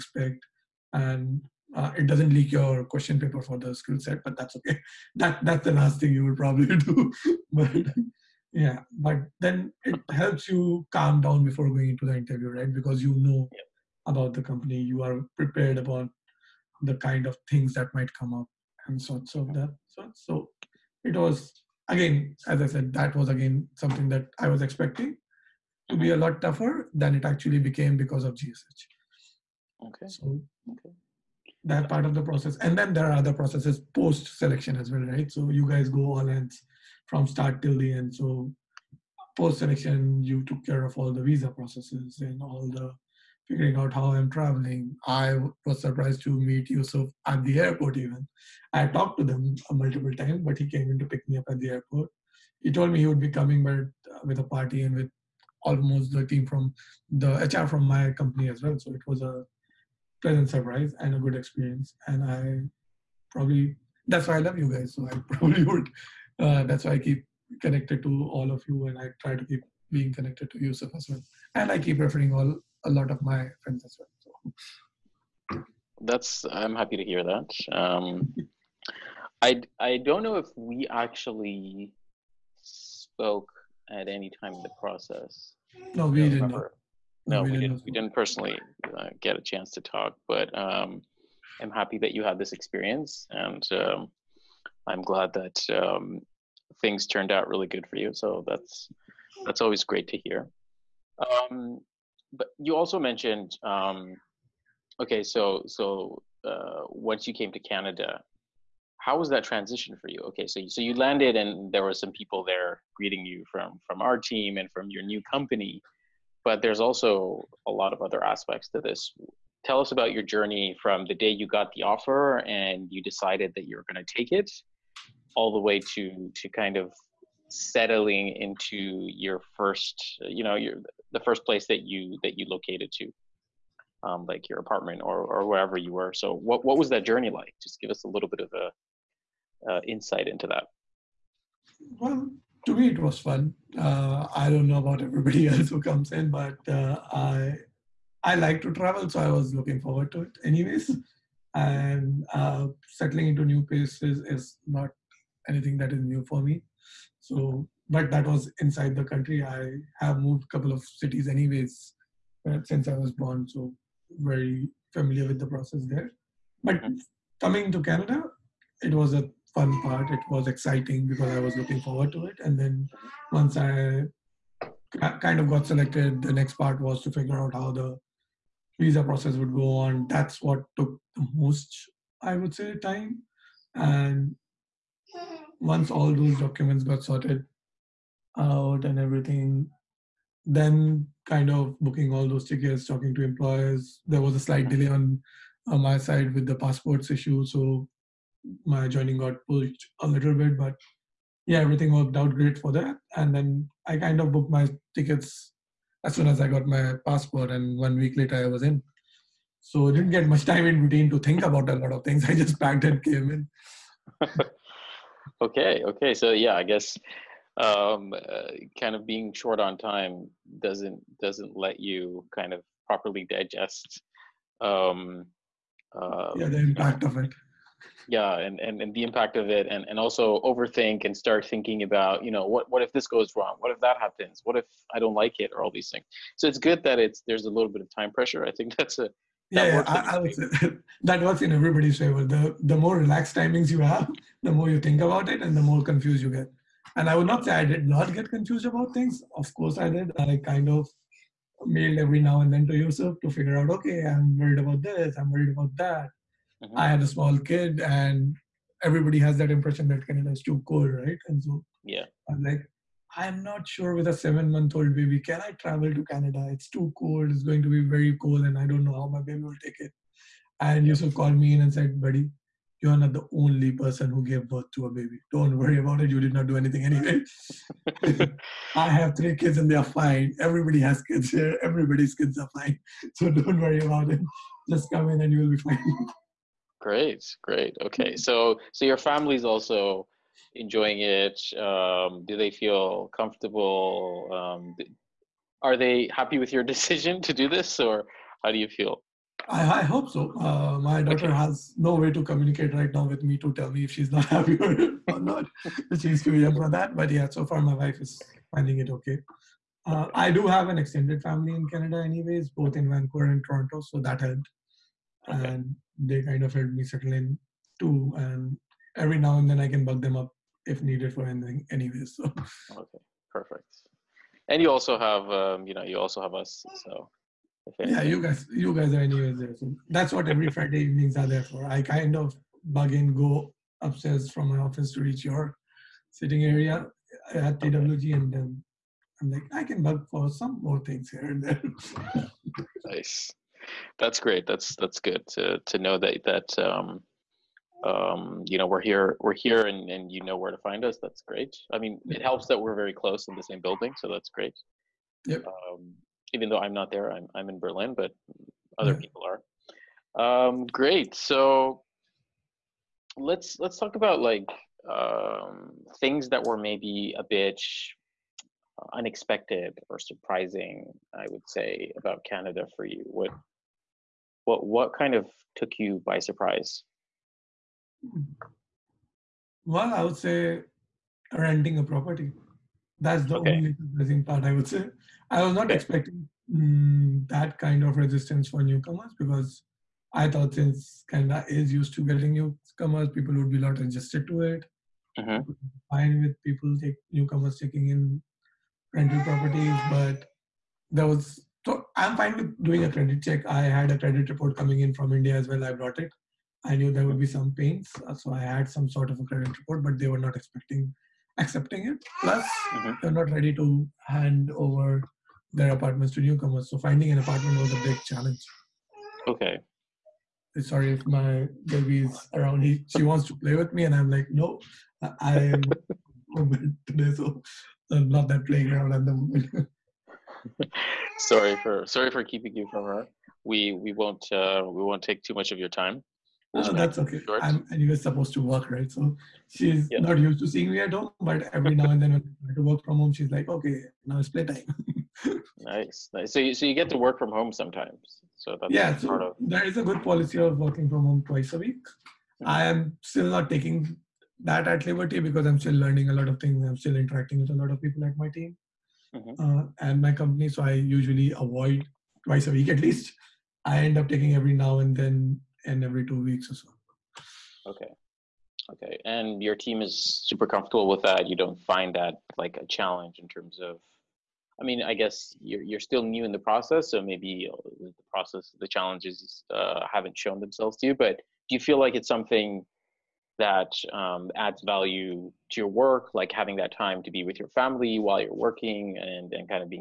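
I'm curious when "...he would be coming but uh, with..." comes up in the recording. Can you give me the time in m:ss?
0:52.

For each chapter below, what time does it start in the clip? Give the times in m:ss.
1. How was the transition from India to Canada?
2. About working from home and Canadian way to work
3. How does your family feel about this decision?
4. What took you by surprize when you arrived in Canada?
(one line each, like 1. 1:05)
1. 1:49
2. 7:29
3. 4:54
4. 6:16.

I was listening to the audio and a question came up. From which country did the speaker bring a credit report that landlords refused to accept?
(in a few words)
India.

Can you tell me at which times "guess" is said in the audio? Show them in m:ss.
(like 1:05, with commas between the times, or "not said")
3:36, 7:54.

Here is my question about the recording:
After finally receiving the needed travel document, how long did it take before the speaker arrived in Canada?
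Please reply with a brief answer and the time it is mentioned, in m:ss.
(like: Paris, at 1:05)
One week, at 3:27.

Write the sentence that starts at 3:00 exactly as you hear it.
That's what took the most, I would say, time.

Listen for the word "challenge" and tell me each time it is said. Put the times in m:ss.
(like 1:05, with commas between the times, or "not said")
6:58, 7:52, 7:58.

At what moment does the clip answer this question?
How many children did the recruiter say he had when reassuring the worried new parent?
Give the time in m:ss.
4:39.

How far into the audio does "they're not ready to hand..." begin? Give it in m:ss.
6:53.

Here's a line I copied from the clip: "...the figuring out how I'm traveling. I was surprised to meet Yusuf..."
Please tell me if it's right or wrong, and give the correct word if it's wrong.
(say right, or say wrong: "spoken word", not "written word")
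right.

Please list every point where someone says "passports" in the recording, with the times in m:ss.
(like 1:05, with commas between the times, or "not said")
3:16, 3:27.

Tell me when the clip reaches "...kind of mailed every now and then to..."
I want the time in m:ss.
4:10.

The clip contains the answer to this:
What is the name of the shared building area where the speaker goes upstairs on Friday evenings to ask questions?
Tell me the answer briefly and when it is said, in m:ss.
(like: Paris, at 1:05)
TWG, at 5:37.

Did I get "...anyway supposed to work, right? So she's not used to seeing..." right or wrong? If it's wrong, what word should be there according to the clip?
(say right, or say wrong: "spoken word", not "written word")
right.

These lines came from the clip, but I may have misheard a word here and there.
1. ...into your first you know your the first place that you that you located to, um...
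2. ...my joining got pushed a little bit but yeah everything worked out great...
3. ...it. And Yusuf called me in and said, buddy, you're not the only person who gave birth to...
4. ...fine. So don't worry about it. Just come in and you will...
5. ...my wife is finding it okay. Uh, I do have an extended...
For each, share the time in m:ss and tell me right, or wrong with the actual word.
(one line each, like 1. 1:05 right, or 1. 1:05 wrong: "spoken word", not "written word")
1. 2:08 right
2. 3:18 right
3. 4:29 right
4. 4:42 right
5. 5:07 right.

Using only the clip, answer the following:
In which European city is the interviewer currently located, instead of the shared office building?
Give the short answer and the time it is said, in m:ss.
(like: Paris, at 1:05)
Berlin, at 5:57.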